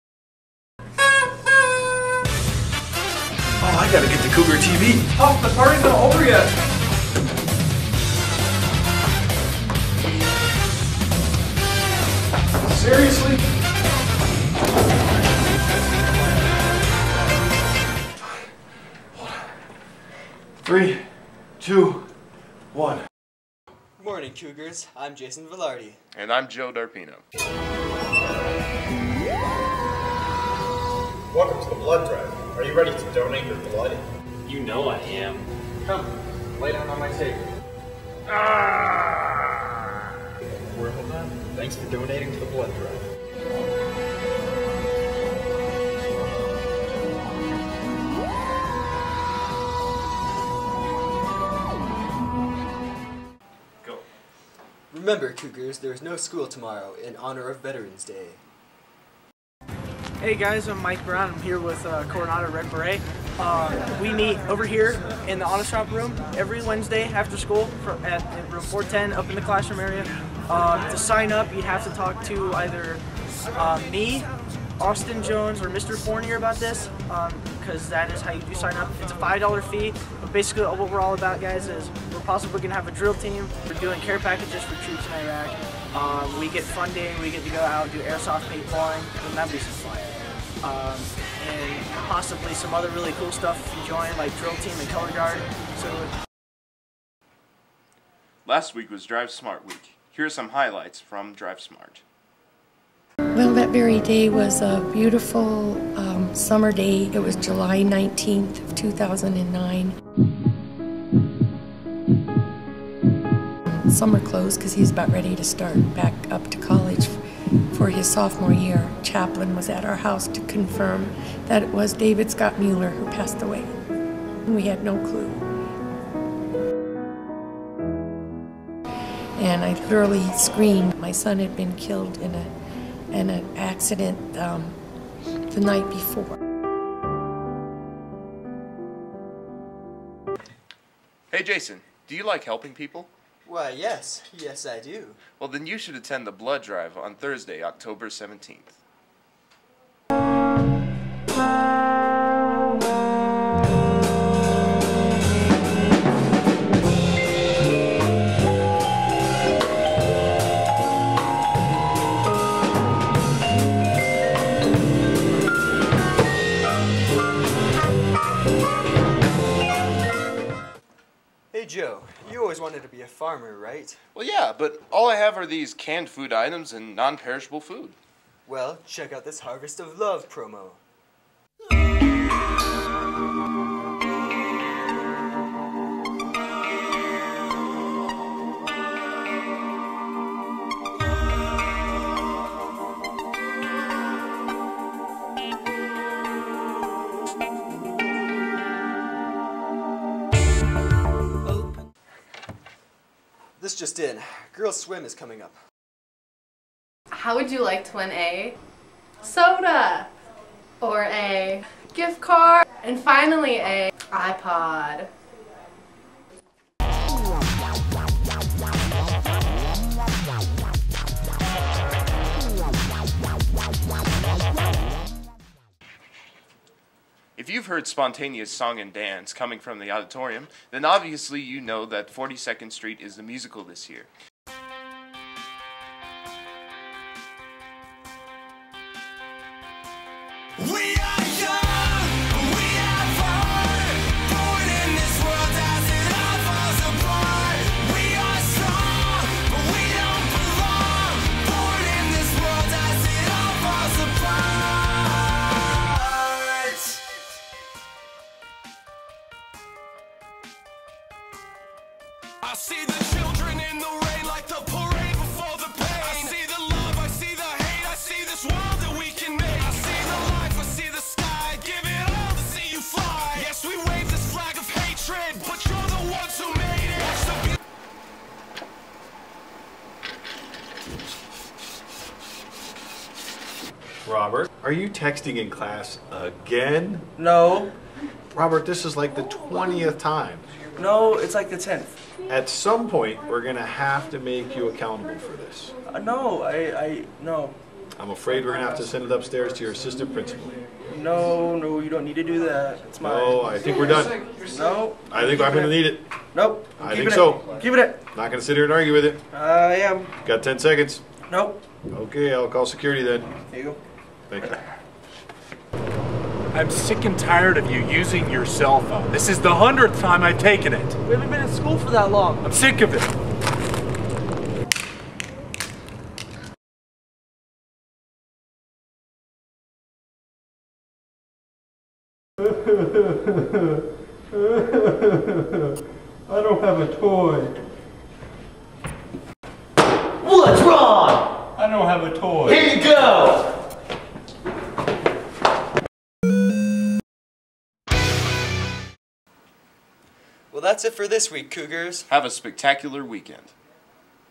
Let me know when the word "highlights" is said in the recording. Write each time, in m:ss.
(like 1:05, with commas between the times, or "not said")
1:40.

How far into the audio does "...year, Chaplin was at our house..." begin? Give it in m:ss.
1:58.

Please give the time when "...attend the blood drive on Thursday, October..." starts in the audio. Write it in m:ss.
2:25.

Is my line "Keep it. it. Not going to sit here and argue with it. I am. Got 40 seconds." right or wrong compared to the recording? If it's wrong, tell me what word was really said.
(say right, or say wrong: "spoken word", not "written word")
wrong: "10", not "40".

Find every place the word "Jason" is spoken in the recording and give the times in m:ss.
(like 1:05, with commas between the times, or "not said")
0:25, 2:21.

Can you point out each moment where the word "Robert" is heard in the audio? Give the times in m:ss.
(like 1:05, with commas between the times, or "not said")
4:44, 4:48.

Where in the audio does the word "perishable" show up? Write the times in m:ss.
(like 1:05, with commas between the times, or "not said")
2:57.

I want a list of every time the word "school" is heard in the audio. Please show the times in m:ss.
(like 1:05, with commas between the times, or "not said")
0:56, 1:07, 5:21.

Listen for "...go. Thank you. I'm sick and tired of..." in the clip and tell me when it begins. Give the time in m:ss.
5:13.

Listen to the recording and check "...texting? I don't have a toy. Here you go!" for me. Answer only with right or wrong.
wrong.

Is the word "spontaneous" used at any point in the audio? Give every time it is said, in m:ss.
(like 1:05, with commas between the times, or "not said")
3:47.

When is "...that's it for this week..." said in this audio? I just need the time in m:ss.
5:50.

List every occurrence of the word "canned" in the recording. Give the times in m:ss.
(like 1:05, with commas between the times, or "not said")
2:55.